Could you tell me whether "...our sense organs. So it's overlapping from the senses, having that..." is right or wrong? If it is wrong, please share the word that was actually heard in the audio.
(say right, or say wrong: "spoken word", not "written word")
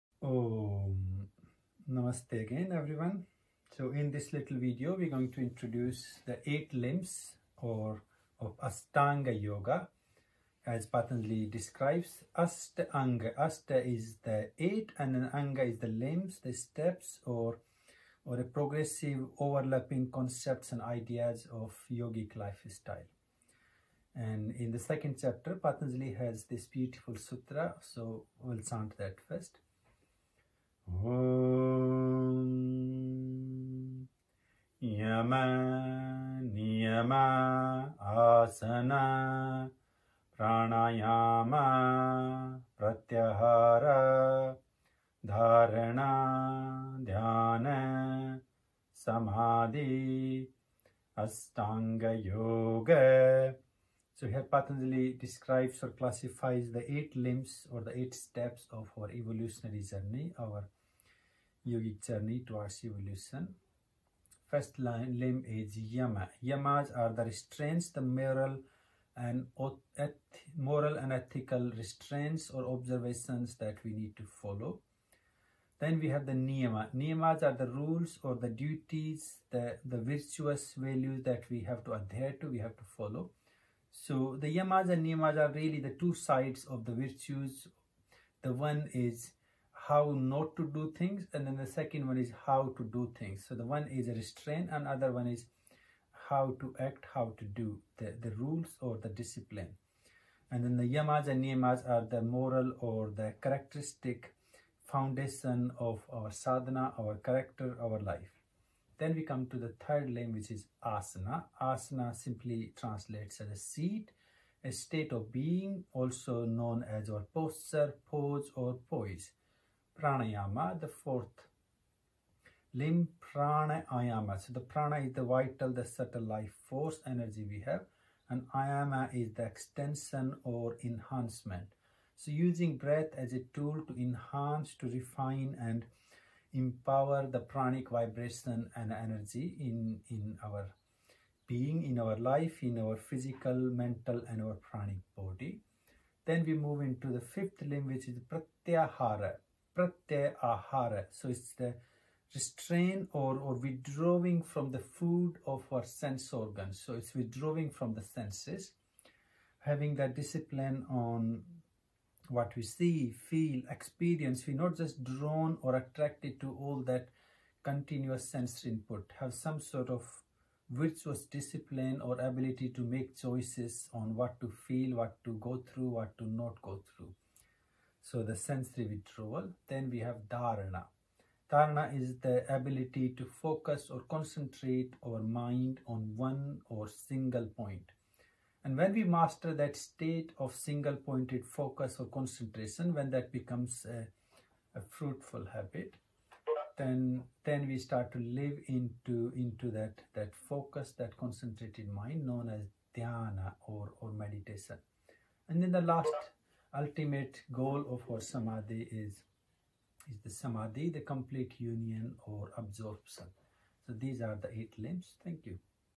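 wrong: "withdrawing", not "overlapping".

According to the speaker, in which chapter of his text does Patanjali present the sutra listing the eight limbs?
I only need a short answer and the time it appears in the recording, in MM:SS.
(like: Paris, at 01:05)
Second chapter, at 00:24.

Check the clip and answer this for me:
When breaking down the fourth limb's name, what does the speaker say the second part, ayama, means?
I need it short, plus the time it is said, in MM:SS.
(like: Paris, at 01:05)
Extension or enhancement, at 02:09.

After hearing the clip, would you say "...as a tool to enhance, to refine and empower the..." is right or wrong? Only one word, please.
right.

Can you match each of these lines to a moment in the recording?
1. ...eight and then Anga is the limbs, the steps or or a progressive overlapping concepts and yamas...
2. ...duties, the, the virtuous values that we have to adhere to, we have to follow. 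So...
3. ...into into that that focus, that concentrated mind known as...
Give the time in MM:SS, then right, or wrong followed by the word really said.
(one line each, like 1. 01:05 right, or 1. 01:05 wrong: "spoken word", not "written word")
1. 00:14 wrong: "ideas", not "yamas"
2. 01:18 right
3. 03:18 right.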